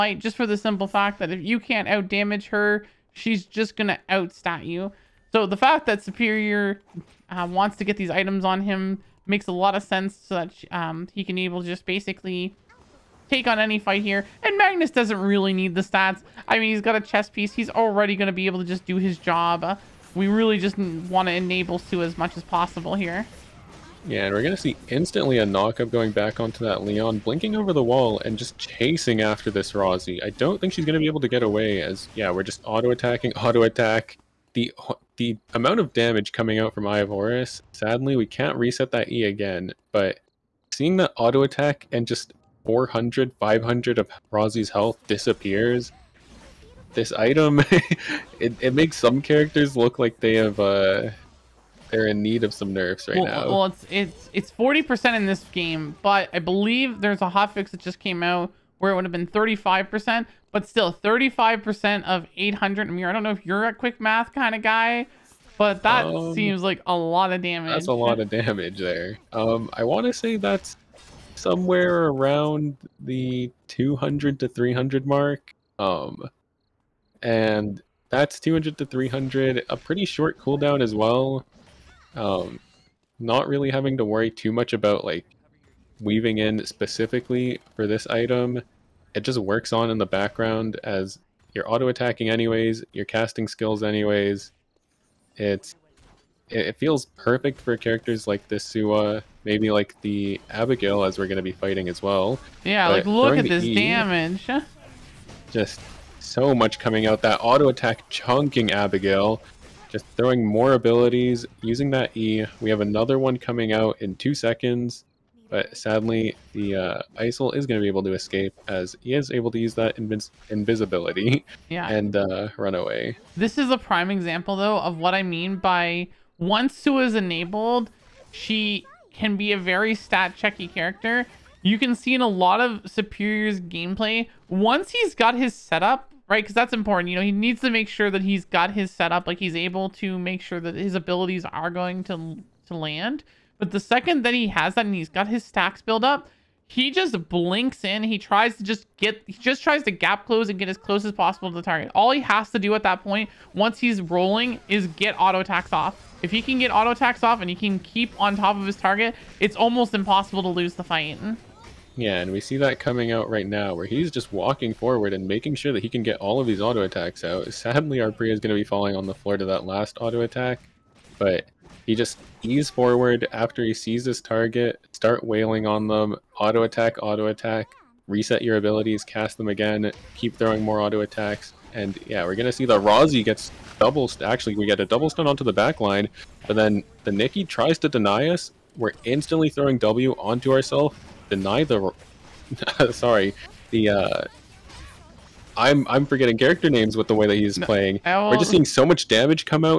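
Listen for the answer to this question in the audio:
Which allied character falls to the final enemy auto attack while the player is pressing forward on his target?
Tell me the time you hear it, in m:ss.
2:48.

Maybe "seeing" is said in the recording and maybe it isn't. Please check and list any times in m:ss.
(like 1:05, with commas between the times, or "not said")
0:40, 3:18.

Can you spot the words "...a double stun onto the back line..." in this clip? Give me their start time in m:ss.
3:04.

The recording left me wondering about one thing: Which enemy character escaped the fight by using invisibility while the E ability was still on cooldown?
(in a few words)
Isol.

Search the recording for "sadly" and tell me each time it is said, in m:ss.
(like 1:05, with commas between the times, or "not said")
0:37, 1:55, 2:47.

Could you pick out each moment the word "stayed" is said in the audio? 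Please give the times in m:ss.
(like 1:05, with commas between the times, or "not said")
not said.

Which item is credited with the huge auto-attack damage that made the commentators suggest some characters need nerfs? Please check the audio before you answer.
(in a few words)
Eye of Horus.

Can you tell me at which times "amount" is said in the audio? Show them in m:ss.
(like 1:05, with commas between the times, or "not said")
0:35.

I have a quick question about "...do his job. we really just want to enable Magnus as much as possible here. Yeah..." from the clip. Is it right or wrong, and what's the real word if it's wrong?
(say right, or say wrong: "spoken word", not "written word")
wrong: "Sua", not "Magnus".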